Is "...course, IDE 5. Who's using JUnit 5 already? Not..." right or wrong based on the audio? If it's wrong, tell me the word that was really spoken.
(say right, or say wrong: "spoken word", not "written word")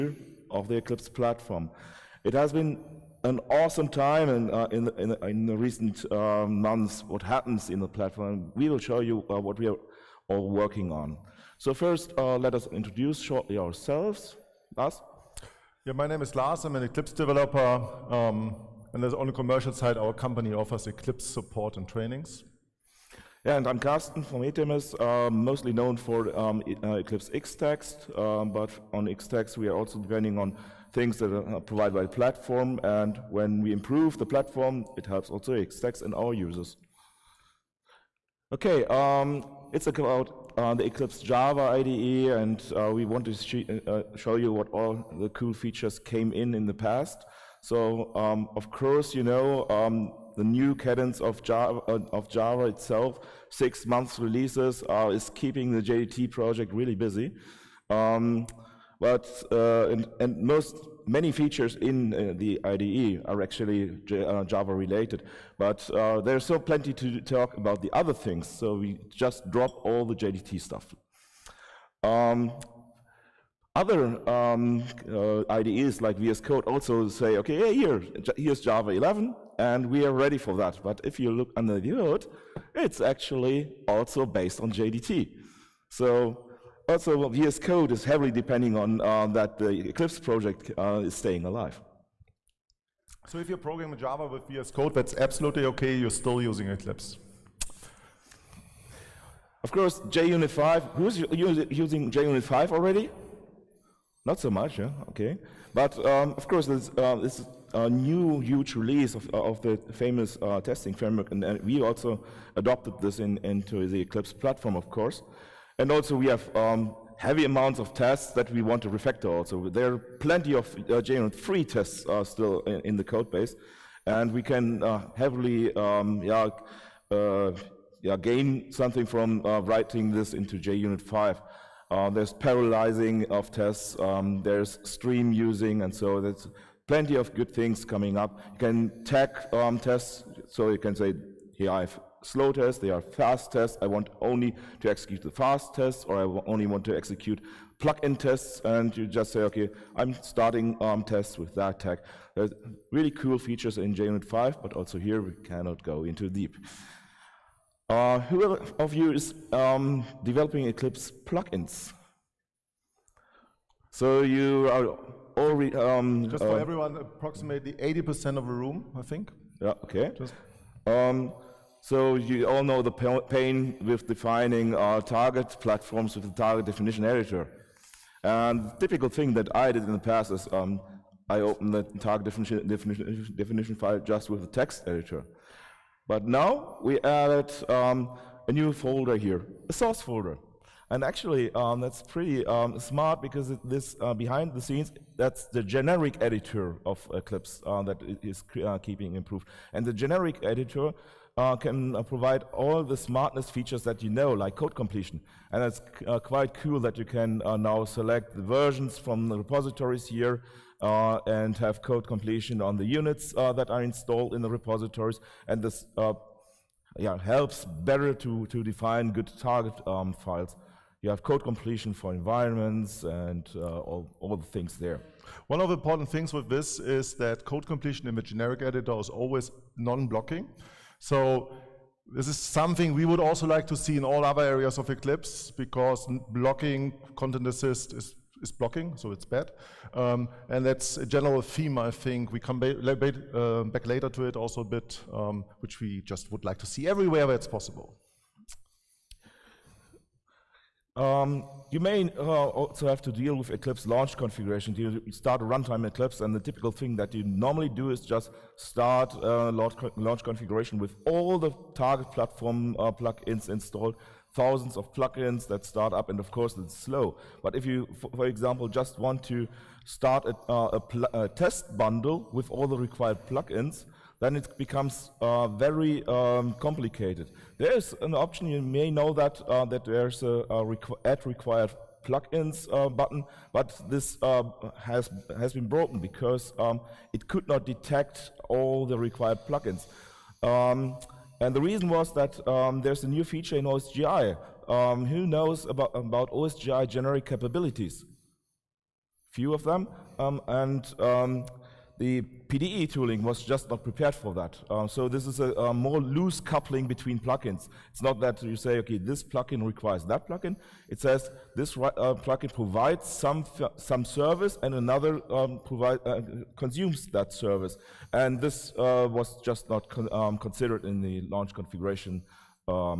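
wrong: "JUnit", not "IDE".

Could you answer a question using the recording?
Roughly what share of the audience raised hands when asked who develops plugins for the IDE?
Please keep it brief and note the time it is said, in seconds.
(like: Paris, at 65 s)
80%, at 167 s.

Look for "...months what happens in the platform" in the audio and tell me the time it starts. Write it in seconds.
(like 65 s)
6 s.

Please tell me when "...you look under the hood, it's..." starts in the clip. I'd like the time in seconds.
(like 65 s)
81 s.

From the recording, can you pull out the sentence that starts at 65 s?
But uh, there's so plenty to talk about the other things, so we just drop all the JDT stuff.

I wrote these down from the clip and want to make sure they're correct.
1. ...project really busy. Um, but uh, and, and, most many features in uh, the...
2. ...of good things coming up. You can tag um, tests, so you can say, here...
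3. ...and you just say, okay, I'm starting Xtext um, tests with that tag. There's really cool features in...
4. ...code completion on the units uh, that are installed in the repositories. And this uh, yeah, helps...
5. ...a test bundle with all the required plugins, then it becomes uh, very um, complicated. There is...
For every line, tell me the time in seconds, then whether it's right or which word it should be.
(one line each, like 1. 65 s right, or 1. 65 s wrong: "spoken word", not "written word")
1. 56 s right
2. 137 s right
3. 148 s wrong: "ARM", not "Xtext"
4. 211 s right
5. 271 s right.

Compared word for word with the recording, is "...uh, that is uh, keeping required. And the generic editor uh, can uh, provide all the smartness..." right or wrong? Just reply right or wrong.
wrong.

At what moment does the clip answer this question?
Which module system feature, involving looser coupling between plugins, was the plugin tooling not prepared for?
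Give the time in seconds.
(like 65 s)
296 s.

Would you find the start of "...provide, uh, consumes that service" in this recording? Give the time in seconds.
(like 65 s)
315 s.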